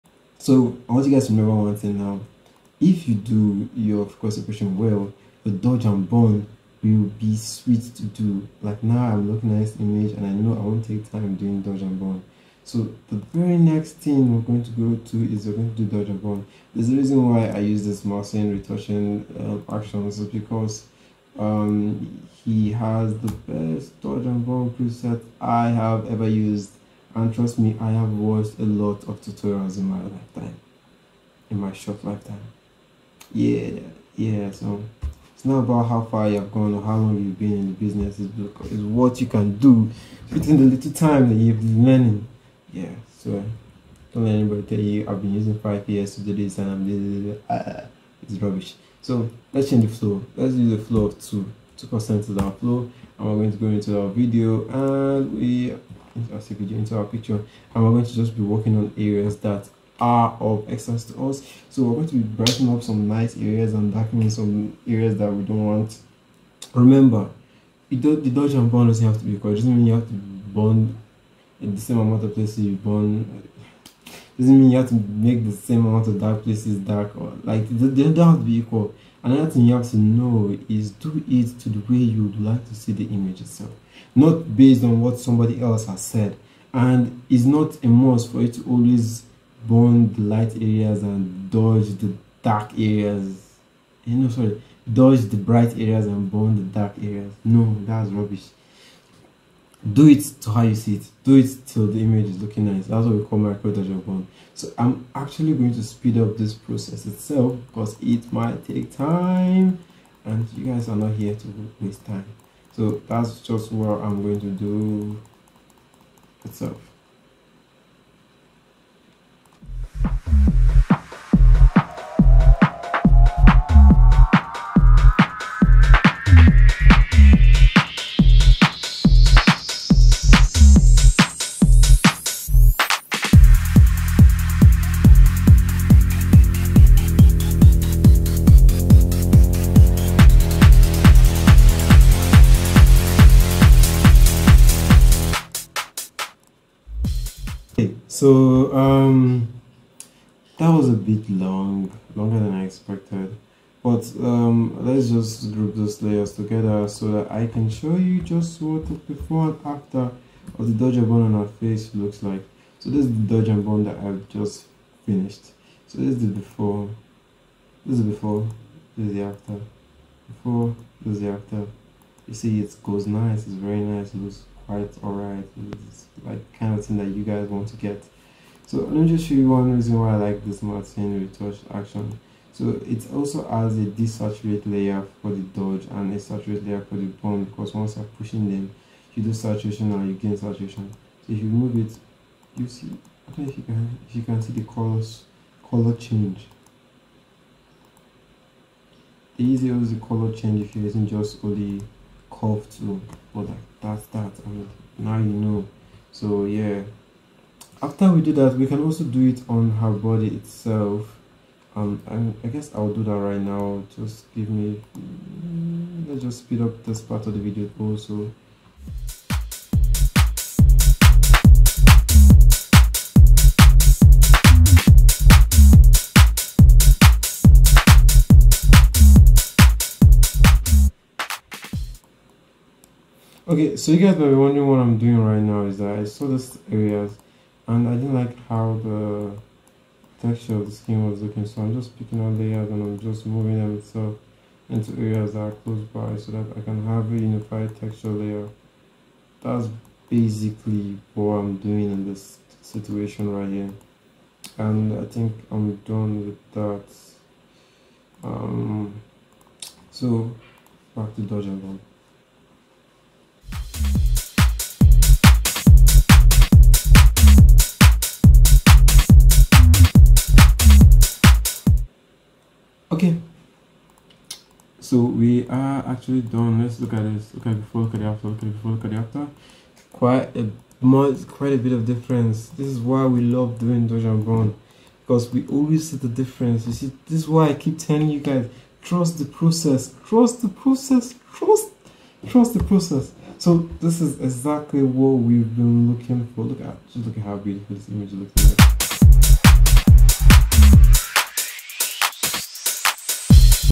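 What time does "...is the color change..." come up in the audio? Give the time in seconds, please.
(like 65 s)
199 s.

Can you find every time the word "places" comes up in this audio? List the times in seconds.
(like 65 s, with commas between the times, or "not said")
72 s, 76 s.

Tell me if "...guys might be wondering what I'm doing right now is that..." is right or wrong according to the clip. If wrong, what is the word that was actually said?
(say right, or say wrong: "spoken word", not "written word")
right.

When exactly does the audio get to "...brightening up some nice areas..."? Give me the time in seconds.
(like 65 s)
62 s.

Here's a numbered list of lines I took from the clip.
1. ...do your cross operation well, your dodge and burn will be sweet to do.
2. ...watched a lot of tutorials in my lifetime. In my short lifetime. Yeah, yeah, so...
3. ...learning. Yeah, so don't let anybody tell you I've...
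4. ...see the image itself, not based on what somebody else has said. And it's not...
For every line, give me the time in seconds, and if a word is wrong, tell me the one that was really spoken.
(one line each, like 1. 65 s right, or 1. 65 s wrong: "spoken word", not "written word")
1. 3 s right
2. 28 s right
3. 41 s right
4. 82 s right.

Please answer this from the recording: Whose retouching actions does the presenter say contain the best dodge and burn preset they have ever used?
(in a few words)
Marcin.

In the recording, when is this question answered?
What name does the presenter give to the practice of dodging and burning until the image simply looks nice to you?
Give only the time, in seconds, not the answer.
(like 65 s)
103 s.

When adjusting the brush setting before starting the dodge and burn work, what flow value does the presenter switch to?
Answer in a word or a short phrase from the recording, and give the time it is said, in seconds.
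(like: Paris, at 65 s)
2, at 51 s.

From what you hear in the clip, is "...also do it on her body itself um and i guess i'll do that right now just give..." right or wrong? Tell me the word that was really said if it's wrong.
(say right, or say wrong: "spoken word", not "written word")
right.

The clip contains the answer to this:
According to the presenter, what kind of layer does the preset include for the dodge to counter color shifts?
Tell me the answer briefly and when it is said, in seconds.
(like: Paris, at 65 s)
desaturate layer, at 183 s.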